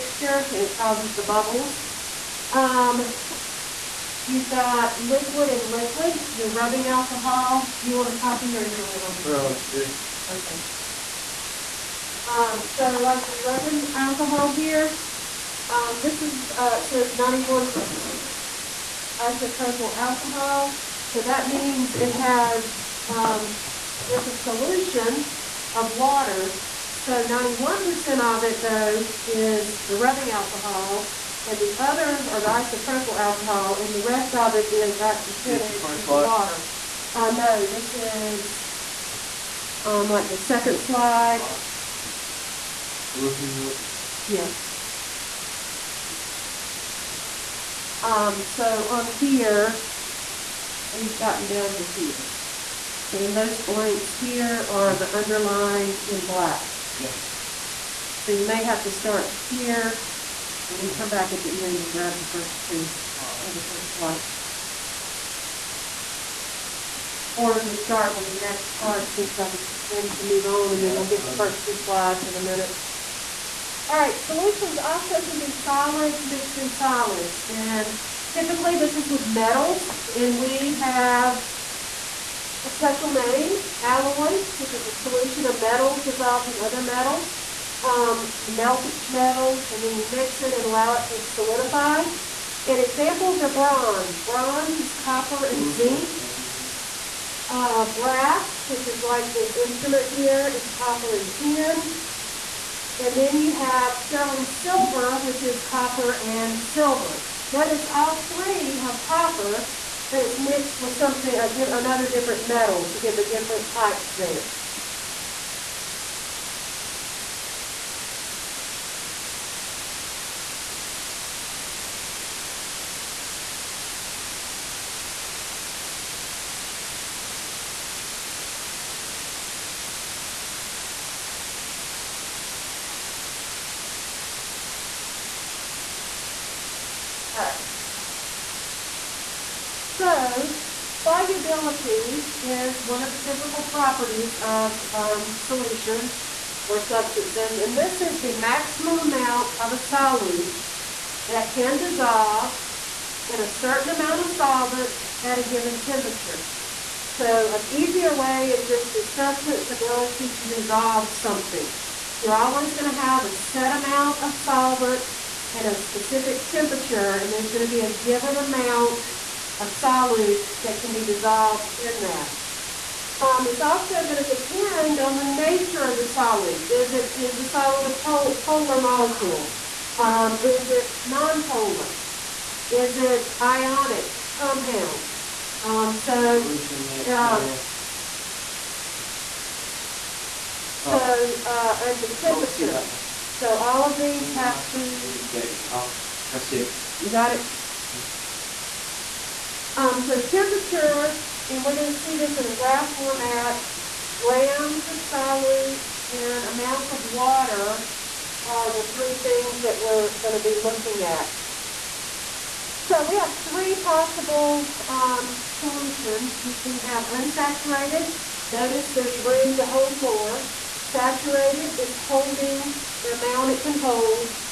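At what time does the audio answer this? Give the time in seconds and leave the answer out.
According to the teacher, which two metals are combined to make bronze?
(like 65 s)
94 s.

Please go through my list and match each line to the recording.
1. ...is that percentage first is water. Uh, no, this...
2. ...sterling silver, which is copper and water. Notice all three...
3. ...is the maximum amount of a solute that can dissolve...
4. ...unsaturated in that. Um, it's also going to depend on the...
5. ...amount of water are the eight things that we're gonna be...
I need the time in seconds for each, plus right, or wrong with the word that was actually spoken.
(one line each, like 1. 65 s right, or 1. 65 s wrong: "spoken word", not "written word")
1. 34 s right
2. 103 s wrong: "silver", not "water"
3. 147 s right
4. 171 s wrong: "dissolved", not "unsaturated"
5. 206 s wrong: "three", not "eight".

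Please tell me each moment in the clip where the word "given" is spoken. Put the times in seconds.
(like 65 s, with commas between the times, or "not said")
155 s, 167 s.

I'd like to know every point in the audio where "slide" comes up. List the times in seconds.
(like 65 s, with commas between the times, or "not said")
40 s, 71 s.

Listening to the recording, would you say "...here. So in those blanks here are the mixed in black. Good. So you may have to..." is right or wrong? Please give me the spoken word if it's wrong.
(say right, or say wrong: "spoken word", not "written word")
wrong: "underlined", not "mixed".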